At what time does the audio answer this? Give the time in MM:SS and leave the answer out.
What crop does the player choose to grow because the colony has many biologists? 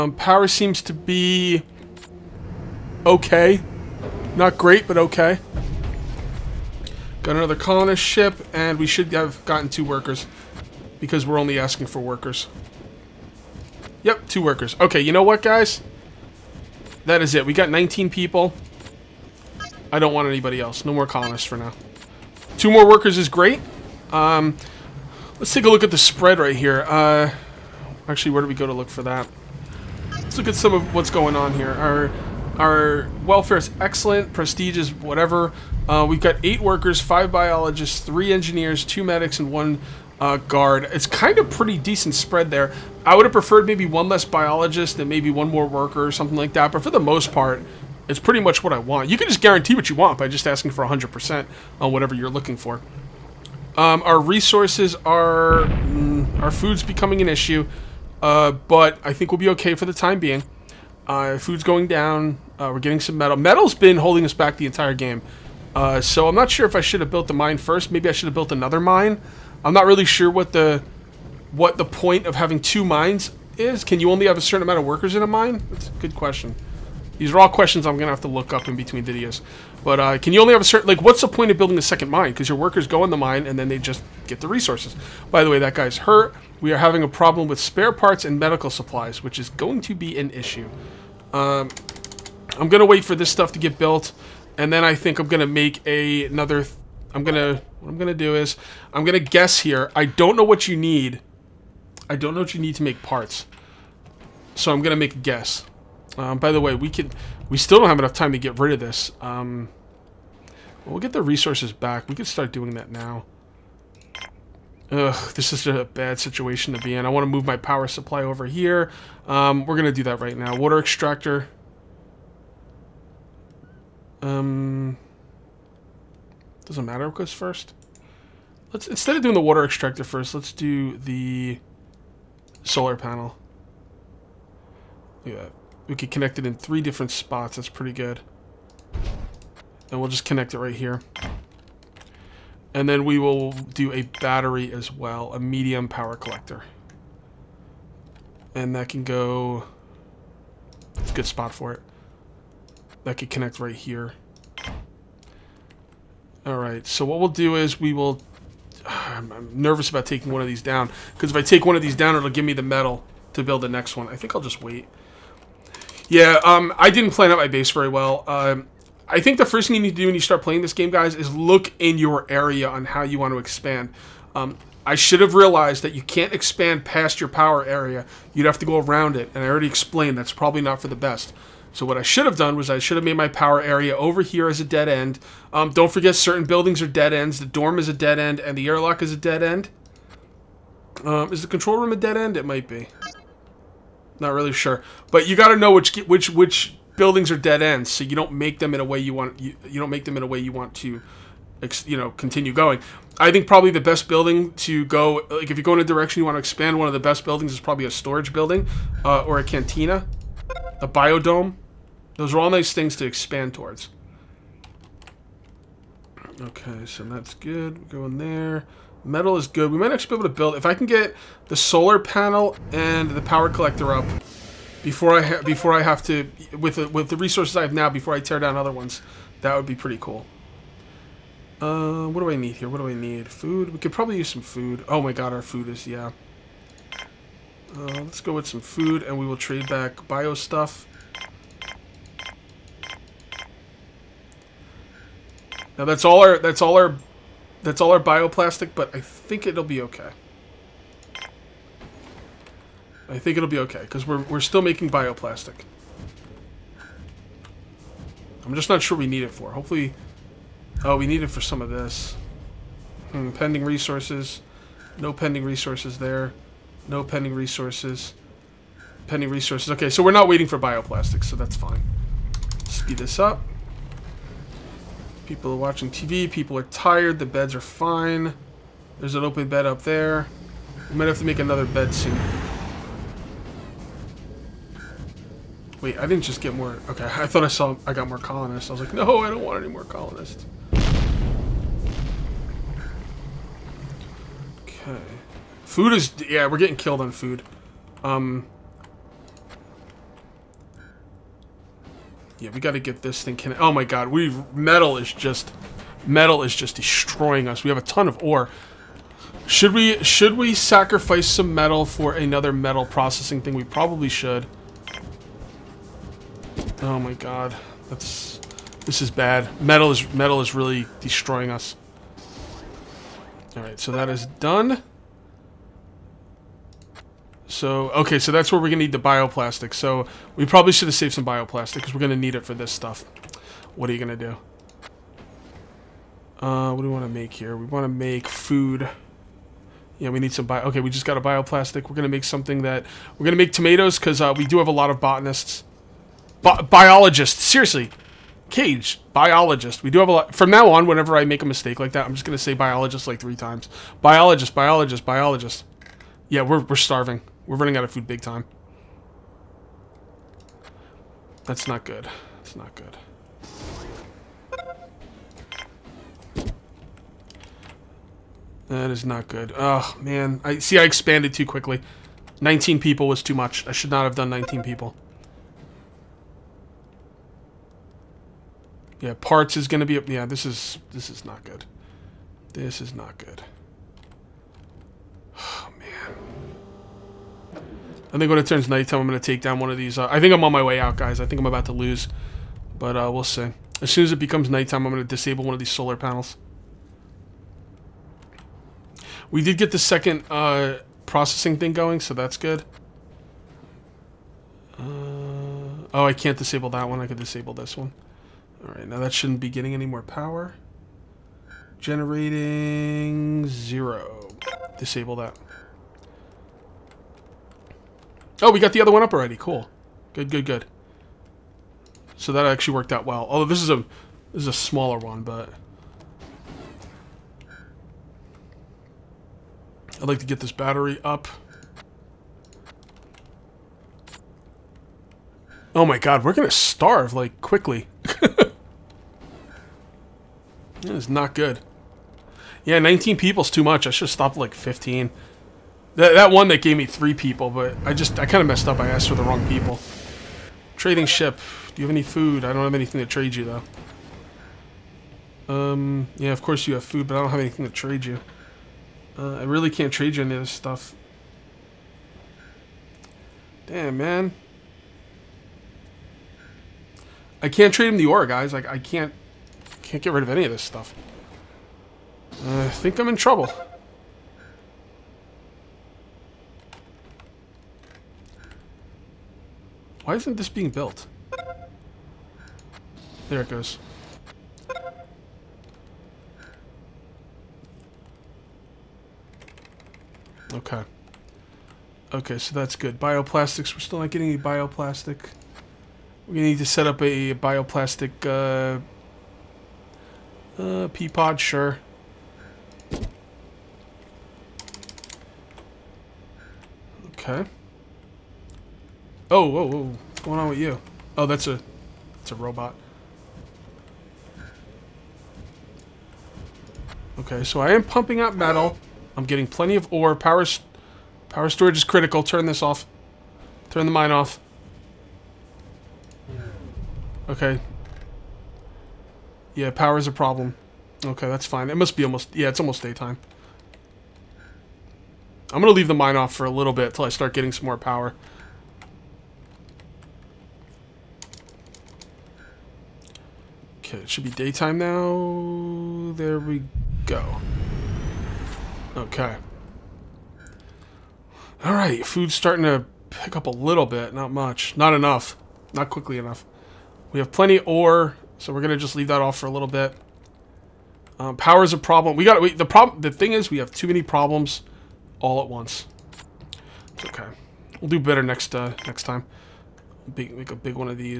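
05:43.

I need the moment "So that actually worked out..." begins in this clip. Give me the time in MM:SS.
07:02.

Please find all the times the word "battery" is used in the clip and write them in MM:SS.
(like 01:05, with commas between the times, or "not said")
02:24, 07:10.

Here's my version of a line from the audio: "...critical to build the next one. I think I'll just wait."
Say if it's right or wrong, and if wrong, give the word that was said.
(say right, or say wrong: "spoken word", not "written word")
wrong: "metal", not "critical".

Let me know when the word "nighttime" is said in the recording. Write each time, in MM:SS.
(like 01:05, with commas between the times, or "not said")
06:28, 06:34.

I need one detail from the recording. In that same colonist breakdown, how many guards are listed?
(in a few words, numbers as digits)
1.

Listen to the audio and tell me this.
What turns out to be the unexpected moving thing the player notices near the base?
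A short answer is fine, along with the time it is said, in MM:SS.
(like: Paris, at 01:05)
A robot, at 08:32.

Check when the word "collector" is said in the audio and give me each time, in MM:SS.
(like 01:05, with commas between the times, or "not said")
02:26, 03:43.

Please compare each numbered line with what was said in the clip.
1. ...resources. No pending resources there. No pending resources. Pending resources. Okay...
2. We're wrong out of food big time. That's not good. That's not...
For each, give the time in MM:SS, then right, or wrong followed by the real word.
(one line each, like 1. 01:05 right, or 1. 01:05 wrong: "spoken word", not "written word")
1. 04:23 right
2. 05:57 wrong: "running", not "wrong".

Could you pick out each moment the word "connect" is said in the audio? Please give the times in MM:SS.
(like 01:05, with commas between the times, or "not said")
02:16, 02:20, 02:33.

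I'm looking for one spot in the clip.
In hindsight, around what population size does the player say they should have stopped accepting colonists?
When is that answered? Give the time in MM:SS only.
07:24.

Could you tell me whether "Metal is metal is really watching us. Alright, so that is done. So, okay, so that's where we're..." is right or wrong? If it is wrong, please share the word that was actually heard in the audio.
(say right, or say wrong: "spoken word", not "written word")
wrong: "destroying", not "watching".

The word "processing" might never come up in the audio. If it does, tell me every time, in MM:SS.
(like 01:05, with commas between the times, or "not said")
05:12, 06:41.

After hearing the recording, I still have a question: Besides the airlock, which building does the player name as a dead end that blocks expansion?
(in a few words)
The dorm.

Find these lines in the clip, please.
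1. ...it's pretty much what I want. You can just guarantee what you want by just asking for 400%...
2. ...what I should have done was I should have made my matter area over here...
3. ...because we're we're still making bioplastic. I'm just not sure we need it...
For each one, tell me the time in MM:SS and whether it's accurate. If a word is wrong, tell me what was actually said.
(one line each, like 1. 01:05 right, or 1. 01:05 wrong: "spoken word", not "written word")
1. 00:48 wrong: "100", not "400"
2. 03:01 wrong: "power", not "matter"
3. 04:13 right.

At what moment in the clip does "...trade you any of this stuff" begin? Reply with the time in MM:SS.
07:39.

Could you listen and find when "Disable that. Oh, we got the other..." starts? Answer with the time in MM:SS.
06:54.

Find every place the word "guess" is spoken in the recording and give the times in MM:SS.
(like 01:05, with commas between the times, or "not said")
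01:39, 01:45.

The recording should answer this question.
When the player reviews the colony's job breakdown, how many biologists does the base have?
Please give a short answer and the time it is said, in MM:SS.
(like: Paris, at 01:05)
5, at 00:37.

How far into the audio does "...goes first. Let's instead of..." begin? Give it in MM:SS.
02:07.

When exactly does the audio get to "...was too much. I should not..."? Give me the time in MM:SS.
06:13.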